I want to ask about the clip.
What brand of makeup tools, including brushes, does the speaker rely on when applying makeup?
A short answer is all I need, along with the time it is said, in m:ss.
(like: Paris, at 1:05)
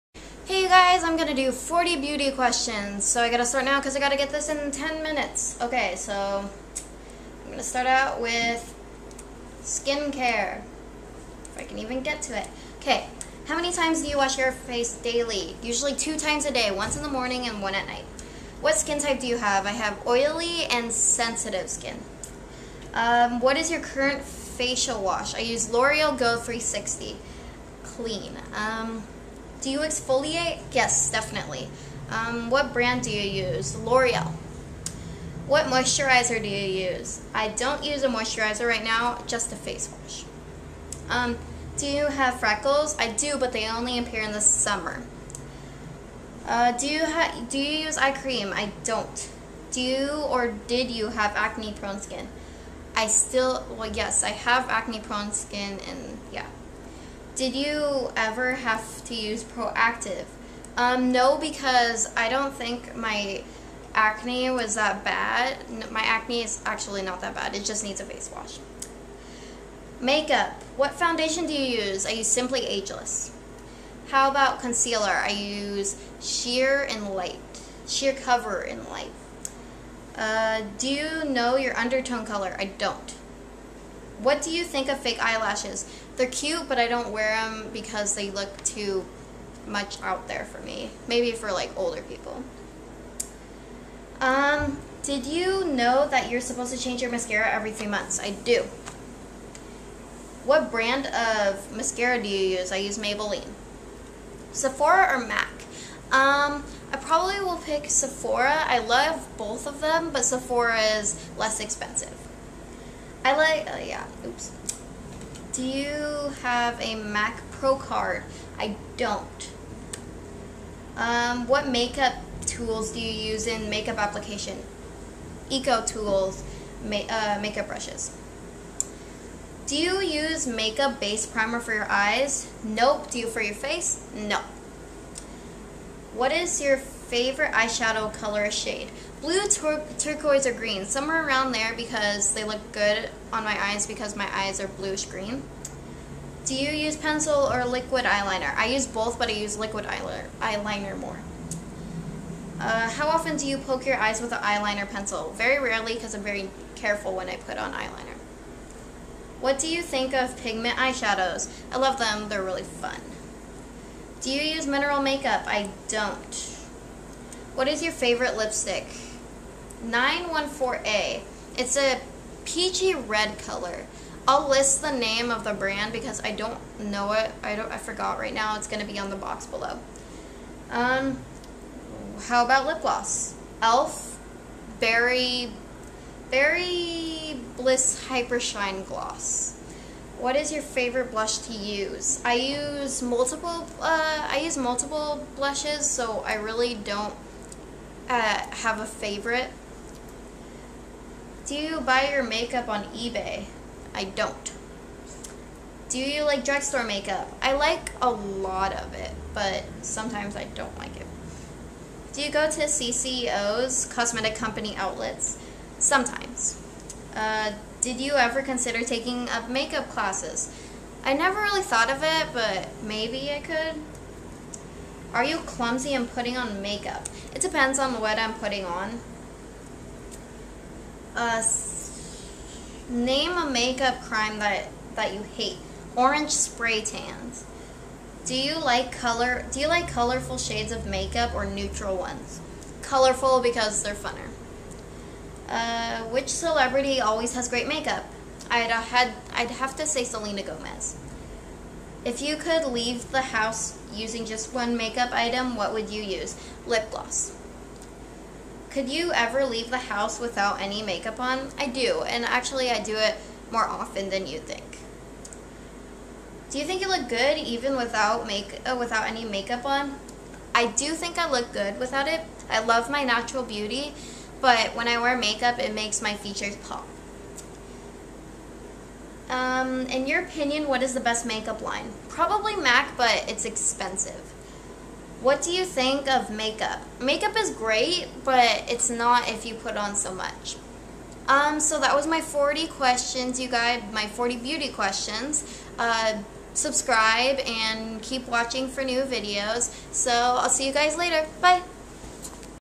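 EcoTools, at 2:05.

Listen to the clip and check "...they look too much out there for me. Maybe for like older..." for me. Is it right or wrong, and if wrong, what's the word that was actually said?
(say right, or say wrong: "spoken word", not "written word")
right.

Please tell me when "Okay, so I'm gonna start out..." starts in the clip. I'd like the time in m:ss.
0:05.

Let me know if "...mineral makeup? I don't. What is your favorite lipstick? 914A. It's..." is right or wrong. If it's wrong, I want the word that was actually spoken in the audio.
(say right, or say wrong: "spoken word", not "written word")
right.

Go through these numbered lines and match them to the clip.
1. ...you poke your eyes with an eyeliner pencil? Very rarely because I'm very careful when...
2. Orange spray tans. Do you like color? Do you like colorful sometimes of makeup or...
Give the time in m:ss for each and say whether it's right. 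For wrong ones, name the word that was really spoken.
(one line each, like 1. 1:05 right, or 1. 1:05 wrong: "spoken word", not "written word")
1. 2:33 right
2. 3:55 wrong: "shades", not "sometimes".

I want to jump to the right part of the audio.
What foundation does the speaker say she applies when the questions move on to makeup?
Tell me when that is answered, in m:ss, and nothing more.
1:12.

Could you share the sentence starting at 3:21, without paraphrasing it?
Do you buy your makeup on eBay?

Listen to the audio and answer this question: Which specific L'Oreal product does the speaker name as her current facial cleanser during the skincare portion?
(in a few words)
Go 360 Clean.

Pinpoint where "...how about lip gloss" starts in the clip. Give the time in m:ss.
3:02.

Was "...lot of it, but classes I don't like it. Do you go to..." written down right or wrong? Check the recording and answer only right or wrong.
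wrong.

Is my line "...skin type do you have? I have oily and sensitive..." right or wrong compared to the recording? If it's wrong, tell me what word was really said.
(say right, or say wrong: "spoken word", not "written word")
right.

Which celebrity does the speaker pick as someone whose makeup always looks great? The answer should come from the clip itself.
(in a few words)
Selena Gomez.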